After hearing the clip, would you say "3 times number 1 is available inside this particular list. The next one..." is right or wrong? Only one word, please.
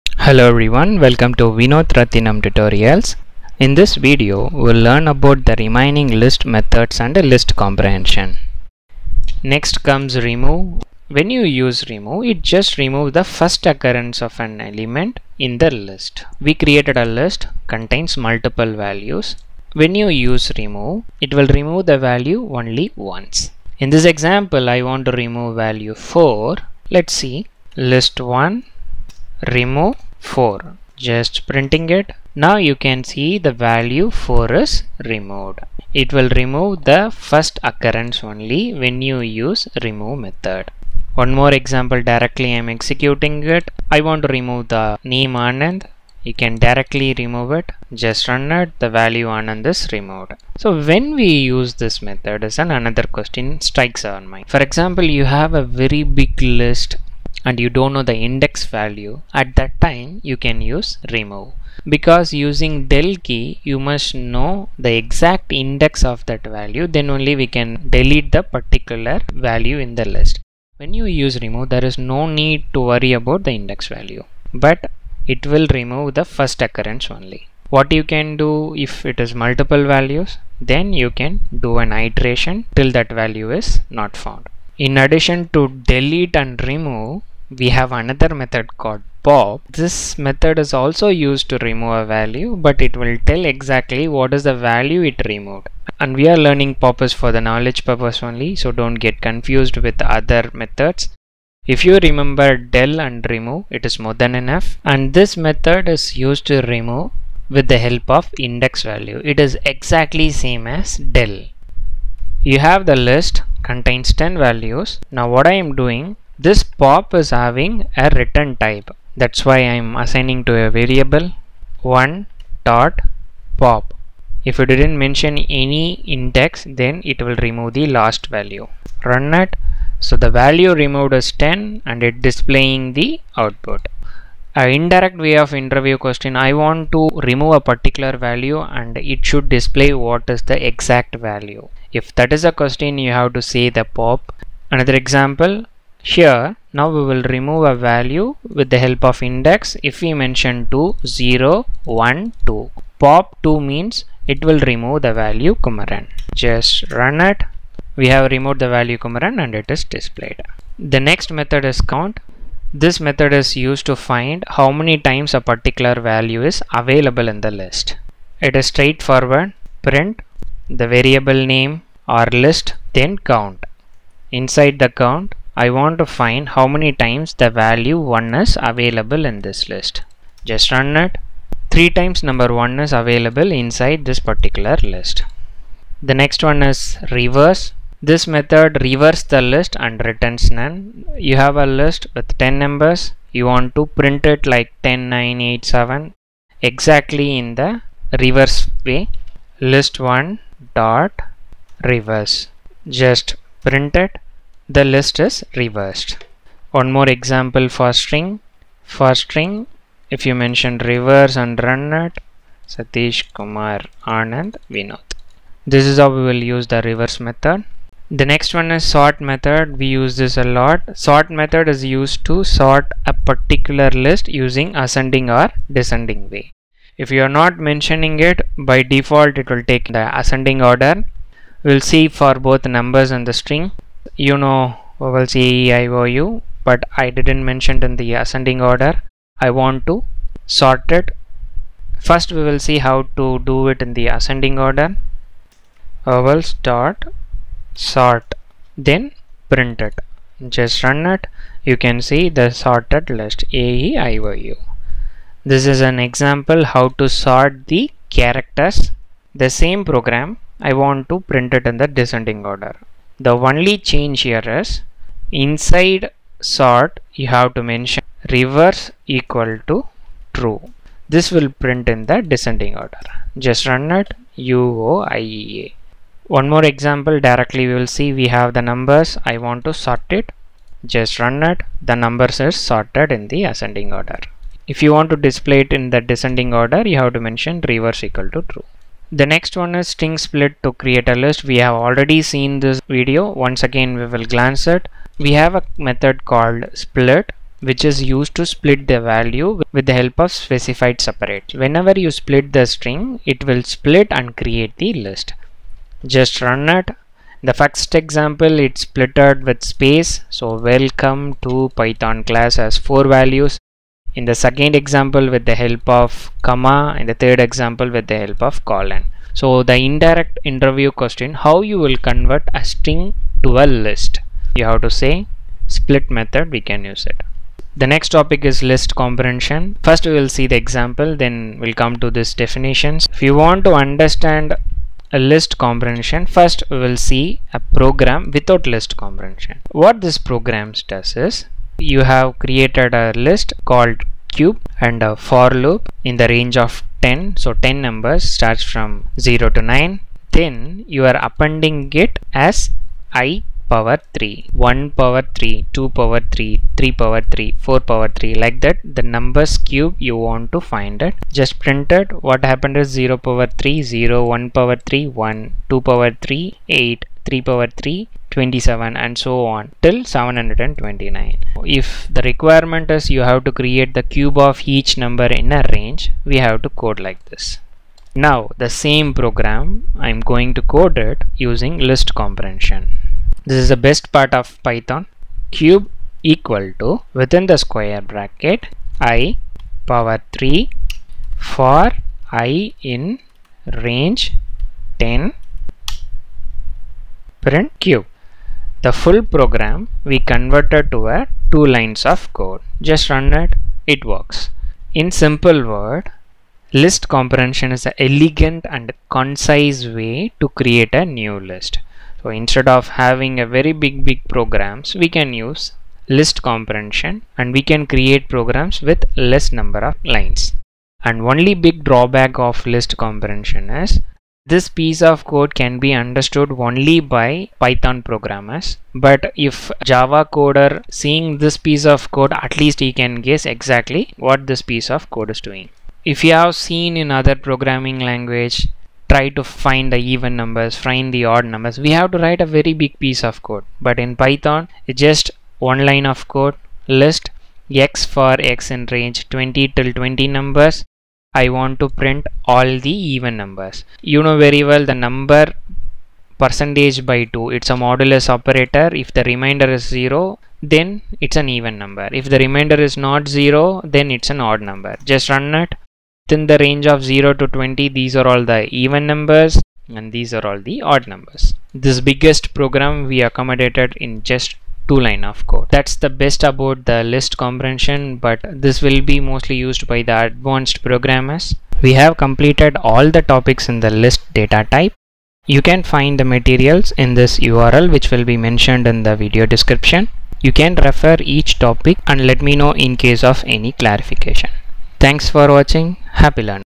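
right.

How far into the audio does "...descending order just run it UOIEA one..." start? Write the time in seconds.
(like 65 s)
272 s.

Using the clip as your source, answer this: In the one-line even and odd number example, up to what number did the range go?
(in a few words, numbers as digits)
20.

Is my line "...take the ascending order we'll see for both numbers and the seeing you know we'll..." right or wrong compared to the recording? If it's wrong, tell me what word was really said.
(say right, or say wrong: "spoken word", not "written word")
wrong: "string", not "seeing".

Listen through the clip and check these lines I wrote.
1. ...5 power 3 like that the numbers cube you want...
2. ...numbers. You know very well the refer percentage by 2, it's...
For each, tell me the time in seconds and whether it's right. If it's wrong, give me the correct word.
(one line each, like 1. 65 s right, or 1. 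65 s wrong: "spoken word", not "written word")
1. 357 s wrong: "4", not "5"
2. 453 s wrong: "number", not "refer".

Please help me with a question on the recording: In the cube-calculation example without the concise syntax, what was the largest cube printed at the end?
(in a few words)
729.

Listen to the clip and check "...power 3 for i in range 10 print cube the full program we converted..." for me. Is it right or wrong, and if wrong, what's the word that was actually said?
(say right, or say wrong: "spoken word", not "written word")
right.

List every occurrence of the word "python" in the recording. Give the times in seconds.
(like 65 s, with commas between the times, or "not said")
311 s, 384 s, 427 s, 444 s.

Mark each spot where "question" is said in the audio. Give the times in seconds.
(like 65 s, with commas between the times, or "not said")
53 s, 135 s, 142 s, 320 s.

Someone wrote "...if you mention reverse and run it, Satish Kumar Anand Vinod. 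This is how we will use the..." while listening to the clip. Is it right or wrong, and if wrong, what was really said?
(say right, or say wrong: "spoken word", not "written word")
right.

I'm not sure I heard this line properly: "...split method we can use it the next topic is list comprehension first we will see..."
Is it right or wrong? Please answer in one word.
right.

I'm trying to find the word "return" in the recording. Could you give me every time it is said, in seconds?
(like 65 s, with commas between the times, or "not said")
118 s, 190 s.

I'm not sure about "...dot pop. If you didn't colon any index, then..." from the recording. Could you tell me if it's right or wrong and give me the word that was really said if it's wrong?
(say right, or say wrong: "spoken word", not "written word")
wrong: "mention", not "colon".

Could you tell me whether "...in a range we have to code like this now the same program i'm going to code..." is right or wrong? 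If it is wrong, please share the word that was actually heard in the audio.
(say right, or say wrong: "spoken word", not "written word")
right.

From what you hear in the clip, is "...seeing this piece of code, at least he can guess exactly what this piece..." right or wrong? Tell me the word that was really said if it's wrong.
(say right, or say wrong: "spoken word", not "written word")
right.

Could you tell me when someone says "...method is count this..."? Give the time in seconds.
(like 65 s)
161 s.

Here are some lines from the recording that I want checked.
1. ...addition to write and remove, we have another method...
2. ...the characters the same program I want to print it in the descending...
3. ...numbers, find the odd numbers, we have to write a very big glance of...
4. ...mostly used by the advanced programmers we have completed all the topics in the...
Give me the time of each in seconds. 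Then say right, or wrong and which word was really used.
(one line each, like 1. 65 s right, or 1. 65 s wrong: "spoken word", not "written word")
1. 84 s wrong: "delete", not "write"
2. 257 s right
3. 440 s wrong: "piece", not "glance"
4. 479 s right.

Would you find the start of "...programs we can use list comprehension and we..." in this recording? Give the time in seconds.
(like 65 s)
414 s.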